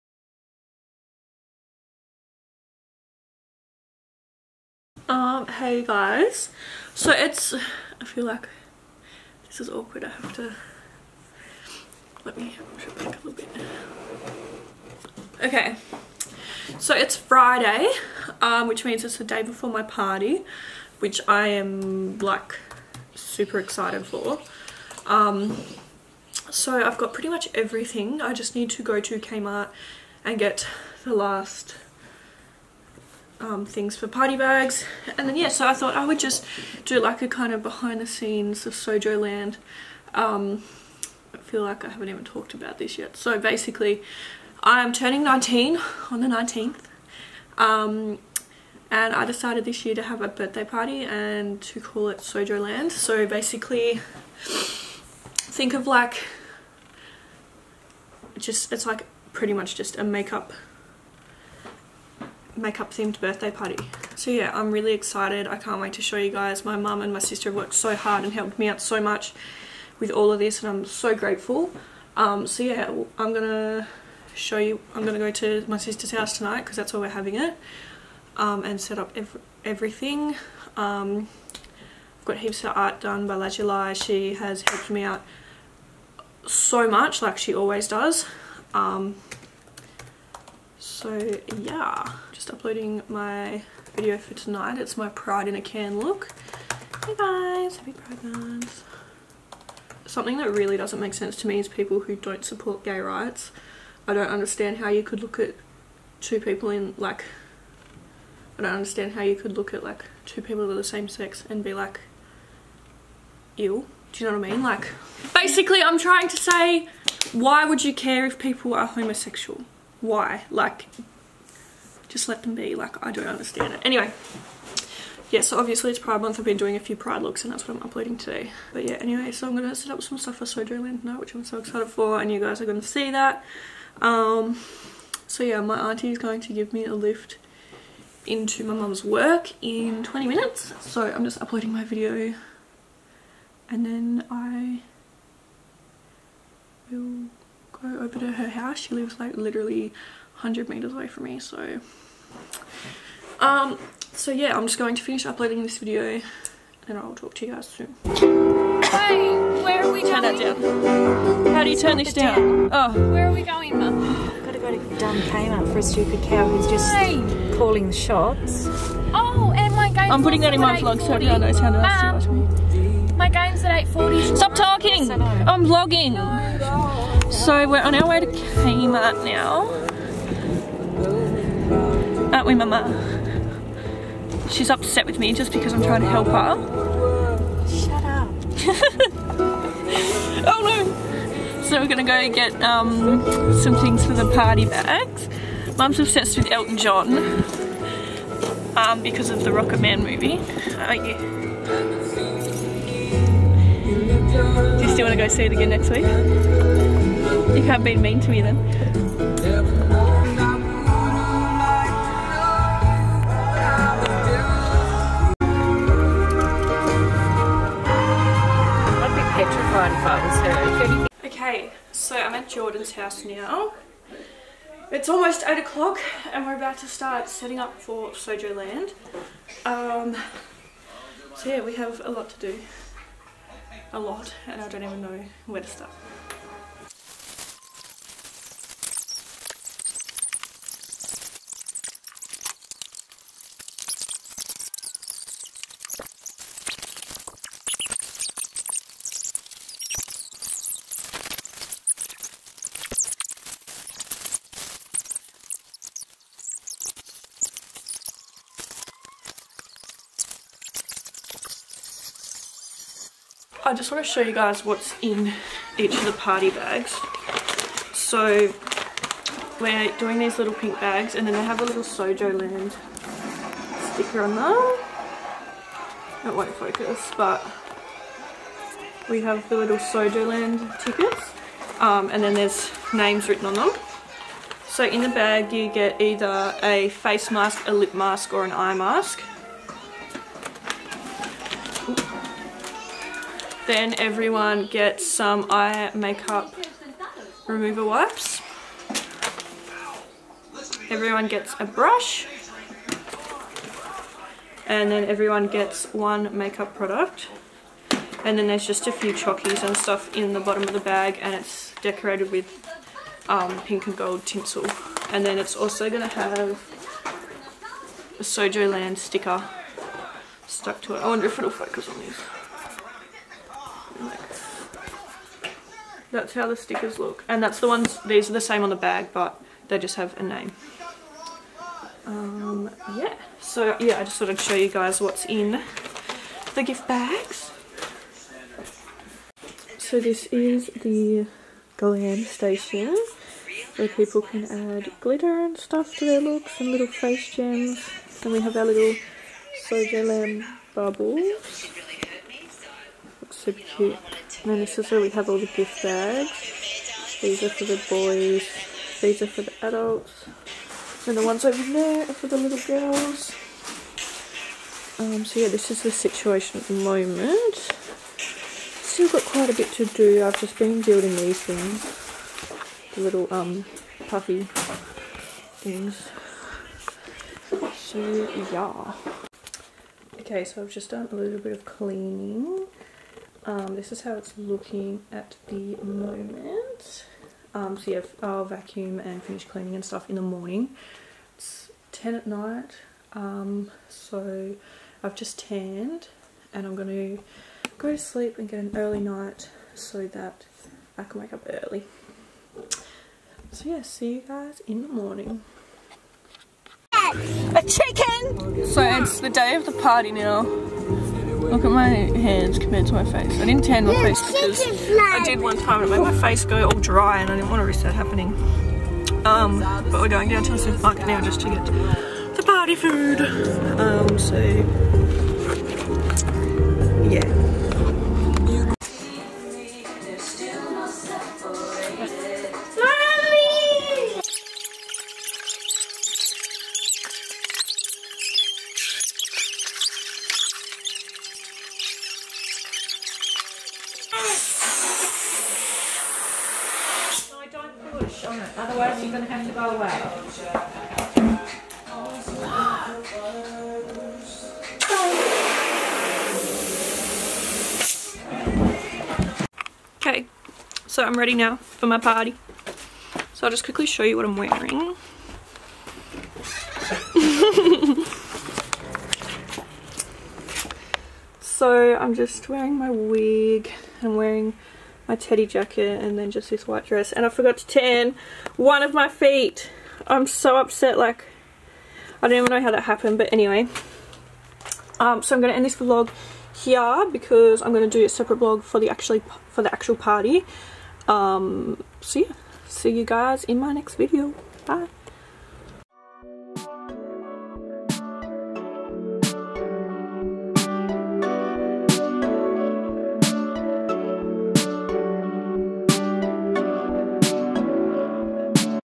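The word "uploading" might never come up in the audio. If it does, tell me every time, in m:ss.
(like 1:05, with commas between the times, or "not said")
1:32, 2:07, 2:21, 2:35.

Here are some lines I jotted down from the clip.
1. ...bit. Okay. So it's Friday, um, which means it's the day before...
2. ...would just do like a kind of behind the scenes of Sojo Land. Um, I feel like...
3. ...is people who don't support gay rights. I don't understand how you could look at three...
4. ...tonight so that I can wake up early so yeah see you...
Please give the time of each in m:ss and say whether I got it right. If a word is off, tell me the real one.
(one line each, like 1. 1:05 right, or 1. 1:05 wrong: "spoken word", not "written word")
1. 0:13 right
2. 0:36 right
3. 1:41 wrong: "two", not "three"
4. 6:38 wrong: "night", not "tonight".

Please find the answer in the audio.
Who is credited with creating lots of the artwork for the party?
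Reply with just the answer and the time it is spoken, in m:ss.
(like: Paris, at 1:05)
Lajulai, at 1:23.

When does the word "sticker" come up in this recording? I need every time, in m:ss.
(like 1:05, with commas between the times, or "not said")
4:33, 5:18, 5:26.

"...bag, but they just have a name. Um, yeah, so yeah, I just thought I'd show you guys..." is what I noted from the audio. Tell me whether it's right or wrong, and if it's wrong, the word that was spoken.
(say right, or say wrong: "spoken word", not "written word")
right.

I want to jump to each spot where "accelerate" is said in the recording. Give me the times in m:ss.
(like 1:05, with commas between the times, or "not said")
not said.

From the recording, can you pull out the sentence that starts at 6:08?
Still got quite a bit to do.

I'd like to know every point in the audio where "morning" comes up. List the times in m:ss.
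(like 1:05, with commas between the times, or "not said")
6:30, 6:44.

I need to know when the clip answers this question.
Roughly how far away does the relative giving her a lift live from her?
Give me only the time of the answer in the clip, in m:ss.
2:30.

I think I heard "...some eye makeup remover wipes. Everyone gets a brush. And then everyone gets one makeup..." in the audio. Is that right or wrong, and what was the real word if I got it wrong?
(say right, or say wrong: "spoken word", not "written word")
right.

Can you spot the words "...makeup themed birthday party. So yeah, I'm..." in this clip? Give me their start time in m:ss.
1:02.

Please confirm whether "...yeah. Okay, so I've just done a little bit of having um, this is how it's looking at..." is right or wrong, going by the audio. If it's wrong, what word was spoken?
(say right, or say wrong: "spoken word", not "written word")
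wrong: "cleaning", not "having".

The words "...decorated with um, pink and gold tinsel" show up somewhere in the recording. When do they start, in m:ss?
5:11.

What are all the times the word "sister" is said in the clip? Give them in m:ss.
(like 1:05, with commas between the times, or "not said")
1:07, 1:15.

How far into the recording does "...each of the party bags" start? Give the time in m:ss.
4:25.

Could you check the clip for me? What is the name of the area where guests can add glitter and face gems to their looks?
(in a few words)
glam station.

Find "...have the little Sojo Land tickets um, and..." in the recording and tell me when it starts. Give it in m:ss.
4:39.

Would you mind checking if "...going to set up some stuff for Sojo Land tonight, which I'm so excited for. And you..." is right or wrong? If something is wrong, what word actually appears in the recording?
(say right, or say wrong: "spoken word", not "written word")
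right.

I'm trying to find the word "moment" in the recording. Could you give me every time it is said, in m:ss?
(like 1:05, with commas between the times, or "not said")
6:06, 6:25.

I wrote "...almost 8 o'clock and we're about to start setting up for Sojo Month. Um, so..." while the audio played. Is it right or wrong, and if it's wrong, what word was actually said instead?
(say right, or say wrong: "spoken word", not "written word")
wrong: "Land", not "Month".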